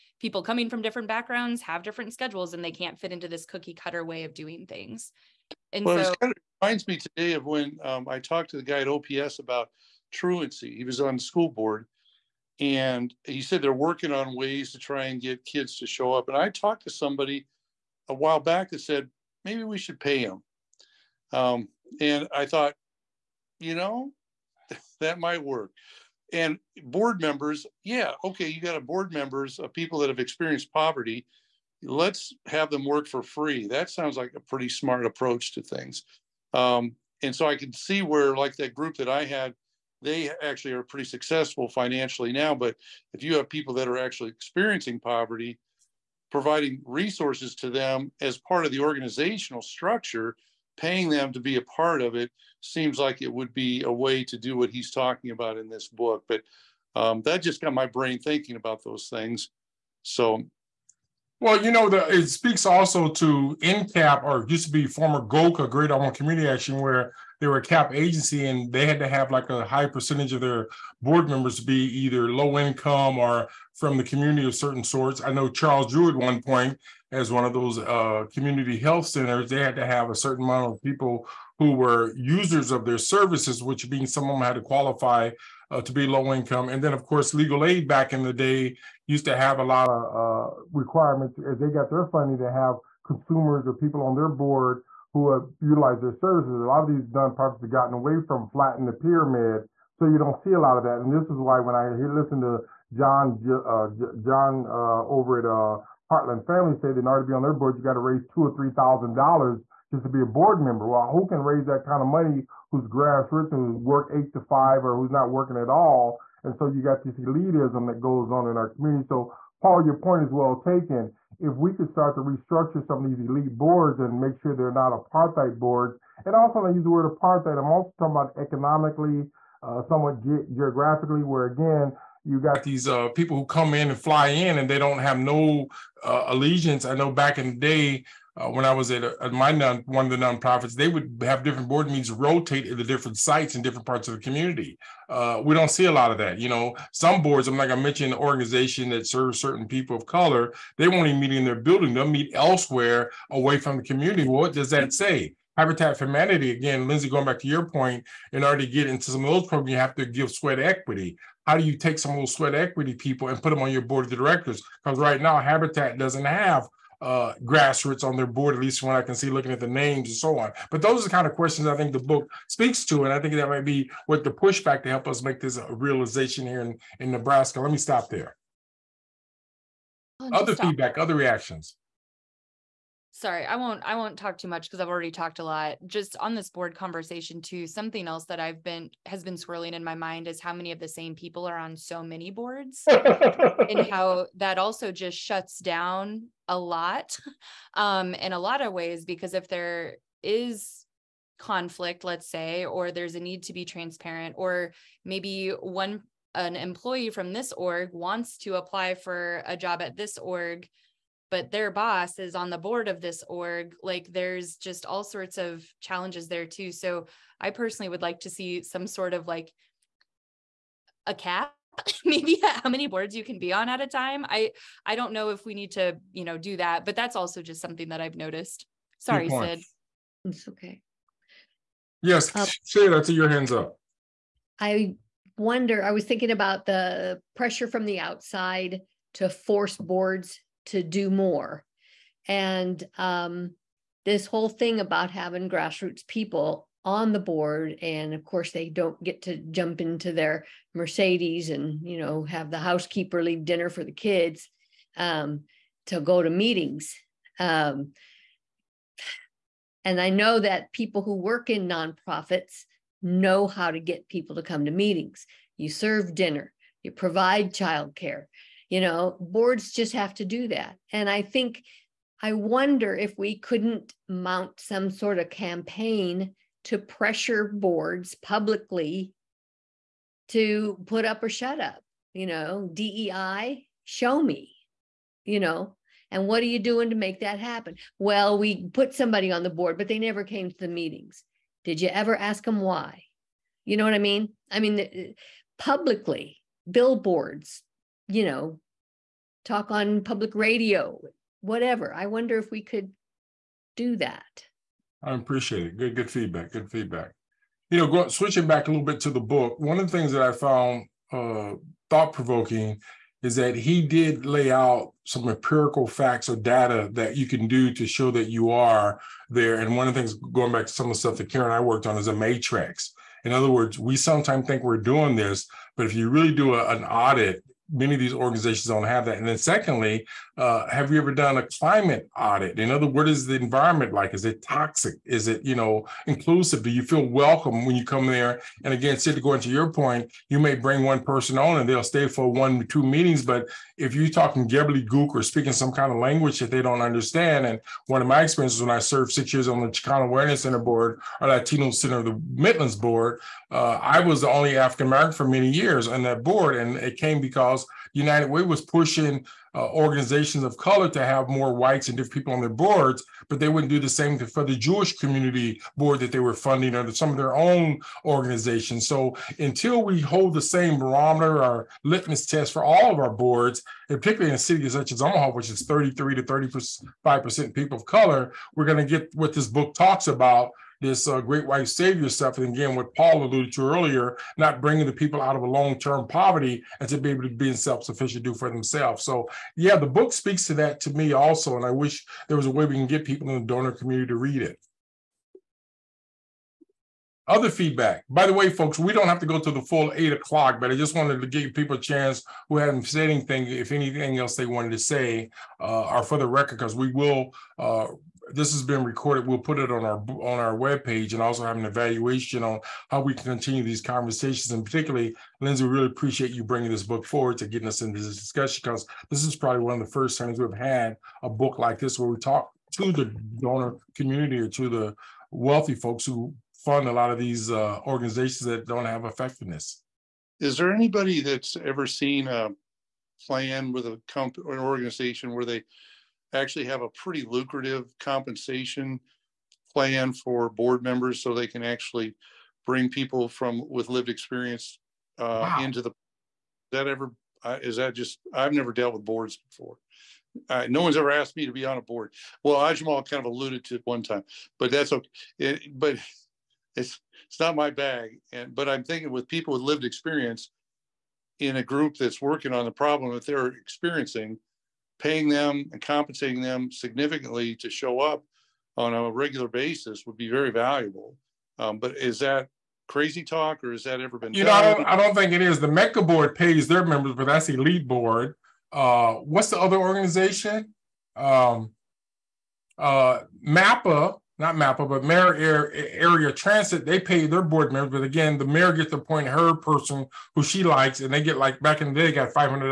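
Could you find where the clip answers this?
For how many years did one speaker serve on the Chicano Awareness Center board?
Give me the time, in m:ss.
5:49.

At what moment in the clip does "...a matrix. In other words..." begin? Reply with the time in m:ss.
5:22.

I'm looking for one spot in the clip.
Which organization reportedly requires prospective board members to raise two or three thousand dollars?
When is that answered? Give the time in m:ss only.
1:46.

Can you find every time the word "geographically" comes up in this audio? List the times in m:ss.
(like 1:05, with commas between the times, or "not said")
2:10.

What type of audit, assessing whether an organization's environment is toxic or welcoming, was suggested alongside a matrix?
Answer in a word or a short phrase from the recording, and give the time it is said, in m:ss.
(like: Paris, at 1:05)
climate audit, at 5:31.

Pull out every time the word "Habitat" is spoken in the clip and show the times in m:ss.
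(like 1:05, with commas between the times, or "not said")
2:35, 2:45.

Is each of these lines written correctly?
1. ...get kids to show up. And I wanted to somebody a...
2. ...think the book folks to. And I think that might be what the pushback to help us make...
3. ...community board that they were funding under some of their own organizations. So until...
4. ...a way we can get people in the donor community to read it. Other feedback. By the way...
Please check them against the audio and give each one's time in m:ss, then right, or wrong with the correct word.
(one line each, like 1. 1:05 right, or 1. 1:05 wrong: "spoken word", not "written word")
1. 0:15 wrong: "talked", not "wanted"
2. 2:51 wrong: "speaks", not "folks"
3. 6:04 right
4. 6:32 right.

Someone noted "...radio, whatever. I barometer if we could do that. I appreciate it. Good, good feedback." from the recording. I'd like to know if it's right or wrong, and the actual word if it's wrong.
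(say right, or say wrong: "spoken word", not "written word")
wrong: "wonder", not "barometer".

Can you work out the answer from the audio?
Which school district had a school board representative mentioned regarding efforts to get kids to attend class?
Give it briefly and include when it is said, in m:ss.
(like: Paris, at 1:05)
OPS, at 0:08.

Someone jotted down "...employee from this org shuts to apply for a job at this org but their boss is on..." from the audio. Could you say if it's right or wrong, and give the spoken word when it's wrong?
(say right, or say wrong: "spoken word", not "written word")
wrong: "wants", not "shuts".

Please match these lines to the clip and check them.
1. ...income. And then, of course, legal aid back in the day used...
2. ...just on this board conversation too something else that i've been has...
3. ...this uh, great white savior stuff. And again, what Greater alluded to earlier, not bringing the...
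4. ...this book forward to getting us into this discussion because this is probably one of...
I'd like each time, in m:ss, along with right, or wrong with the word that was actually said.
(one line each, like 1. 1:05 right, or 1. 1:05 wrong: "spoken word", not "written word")
1. 1:26 right
2. 3:05 right
3. 6:20 wrong: "Paul", not "Greater"
4. 6:56 right.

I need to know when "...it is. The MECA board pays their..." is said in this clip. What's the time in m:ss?
7:55.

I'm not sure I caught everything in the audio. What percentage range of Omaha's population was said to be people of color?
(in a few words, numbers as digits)
33 to 35%.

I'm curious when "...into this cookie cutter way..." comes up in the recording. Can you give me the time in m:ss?
0:03.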